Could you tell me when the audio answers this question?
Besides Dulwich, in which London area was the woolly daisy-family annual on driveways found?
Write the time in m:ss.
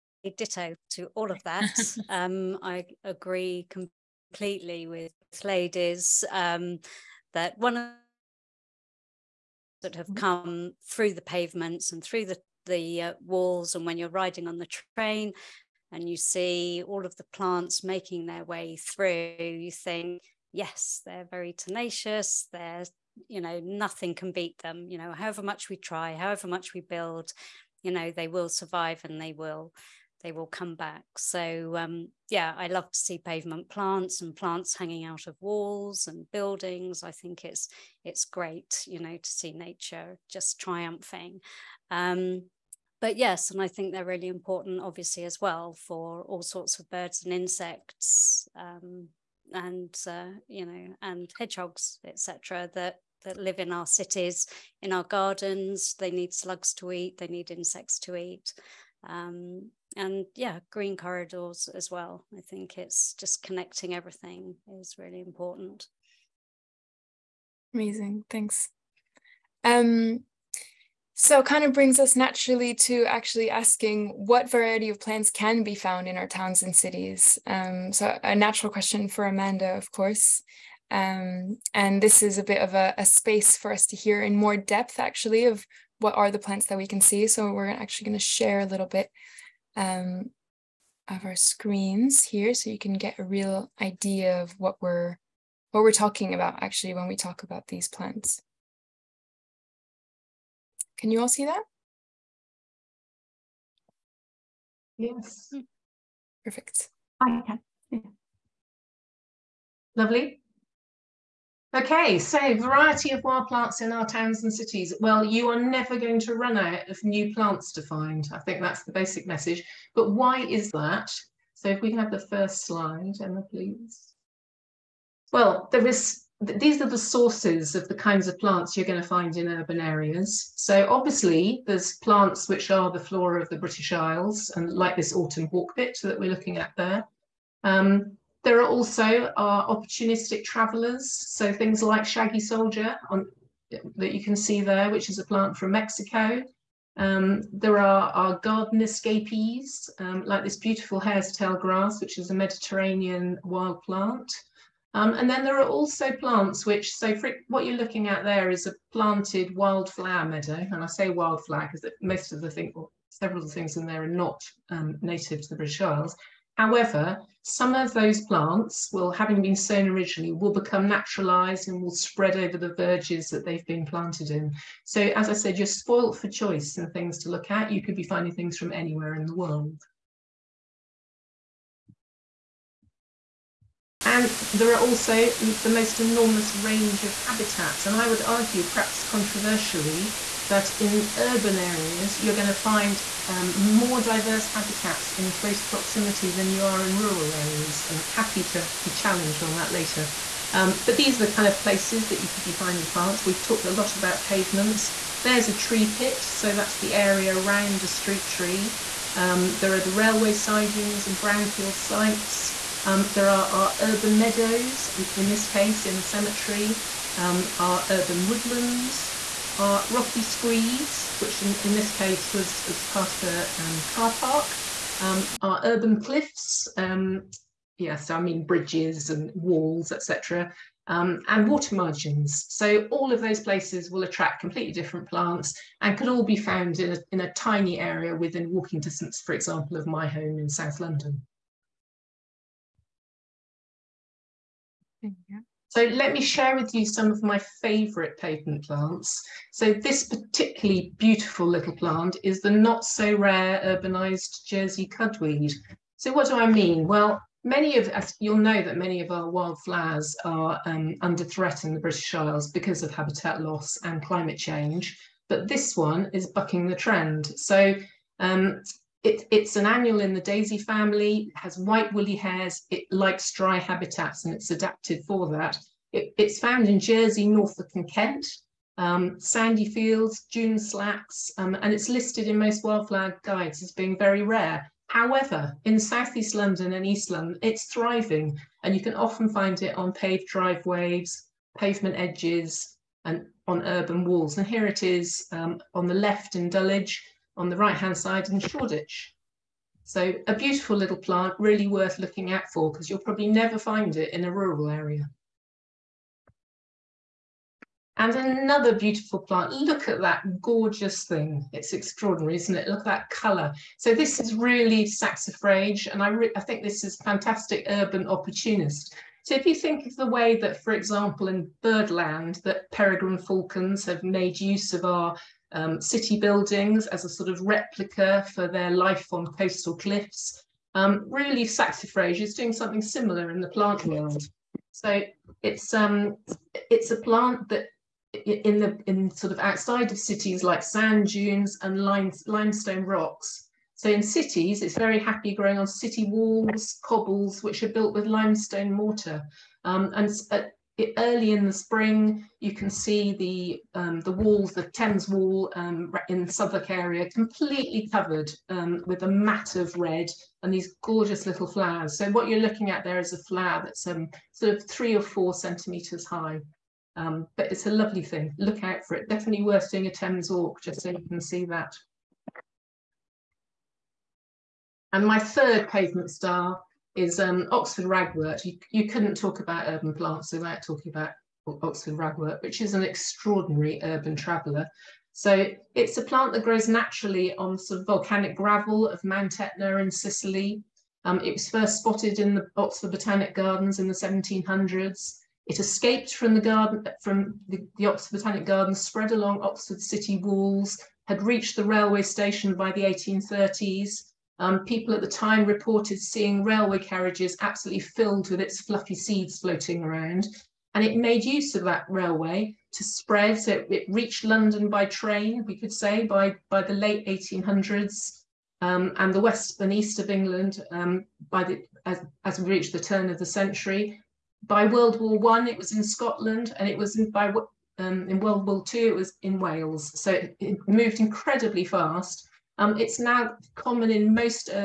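4:58.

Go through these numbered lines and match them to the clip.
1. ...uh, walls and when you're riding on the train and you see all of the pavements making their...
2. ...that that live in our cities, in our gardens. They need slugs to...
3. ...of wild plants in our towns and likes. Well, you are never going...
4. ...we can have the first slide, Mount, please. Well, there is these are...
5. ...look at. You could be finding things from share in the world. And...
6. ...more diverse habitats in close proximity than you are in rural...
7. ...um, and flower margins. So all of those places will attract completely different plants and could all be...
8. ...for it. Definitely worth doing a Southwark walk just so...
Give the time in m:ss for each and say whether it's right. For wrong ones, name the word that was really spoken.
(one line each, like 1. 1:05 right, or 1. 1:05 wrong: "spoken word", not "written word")
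1. 0:13 wrong: "plants", not "pavements"
2. 0:52 right
3. 1:53 wrong: "cities", not "likes"
4. 2:01 wrong: "Emma", not "Mount"
5. 2:57 wrong: "anywhere", not "share"
6. 3:13 right
7. 3:50 wrong: "water", not "flower"
8. 6:08 wrong: "Thames", not "Southwark".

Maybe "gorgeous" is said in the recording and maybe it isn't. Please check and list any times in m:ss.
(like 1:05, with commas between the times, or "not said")
5:10, 6:00.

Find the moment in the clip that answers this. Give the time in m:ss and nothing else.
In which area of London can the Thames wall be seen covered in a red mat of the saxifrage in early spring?
5:56.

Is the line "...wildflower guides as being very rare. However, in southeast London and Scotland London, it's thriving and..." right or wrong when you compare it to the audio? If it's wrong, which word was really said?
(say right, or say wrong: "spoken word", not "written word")
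wrong: "East", not "Scotland".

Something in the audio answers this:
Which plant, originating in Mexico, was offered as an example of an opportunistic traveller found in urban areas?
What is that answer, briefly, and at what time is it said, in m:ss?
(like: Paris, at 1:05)
shaggy soldier, at 2:22.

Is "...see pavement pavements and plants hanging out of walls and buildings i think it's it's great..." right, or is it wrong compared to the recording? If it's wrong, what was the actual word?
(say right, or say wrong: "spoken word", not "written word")
wrong: "plants", not "pavements".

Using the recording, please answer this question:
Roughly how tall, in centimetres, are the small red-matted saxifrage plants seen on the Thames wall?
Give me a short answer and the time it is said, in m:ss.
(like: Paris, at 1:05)
3 or 4 centimetres, at 6:04.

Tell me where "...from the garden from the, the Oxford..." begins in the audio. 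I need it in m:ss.
6:36.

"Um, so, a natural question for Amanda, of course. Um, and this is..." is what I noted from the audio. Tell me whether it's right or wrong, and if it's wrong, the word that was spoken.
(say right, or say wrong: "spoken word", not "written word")
right.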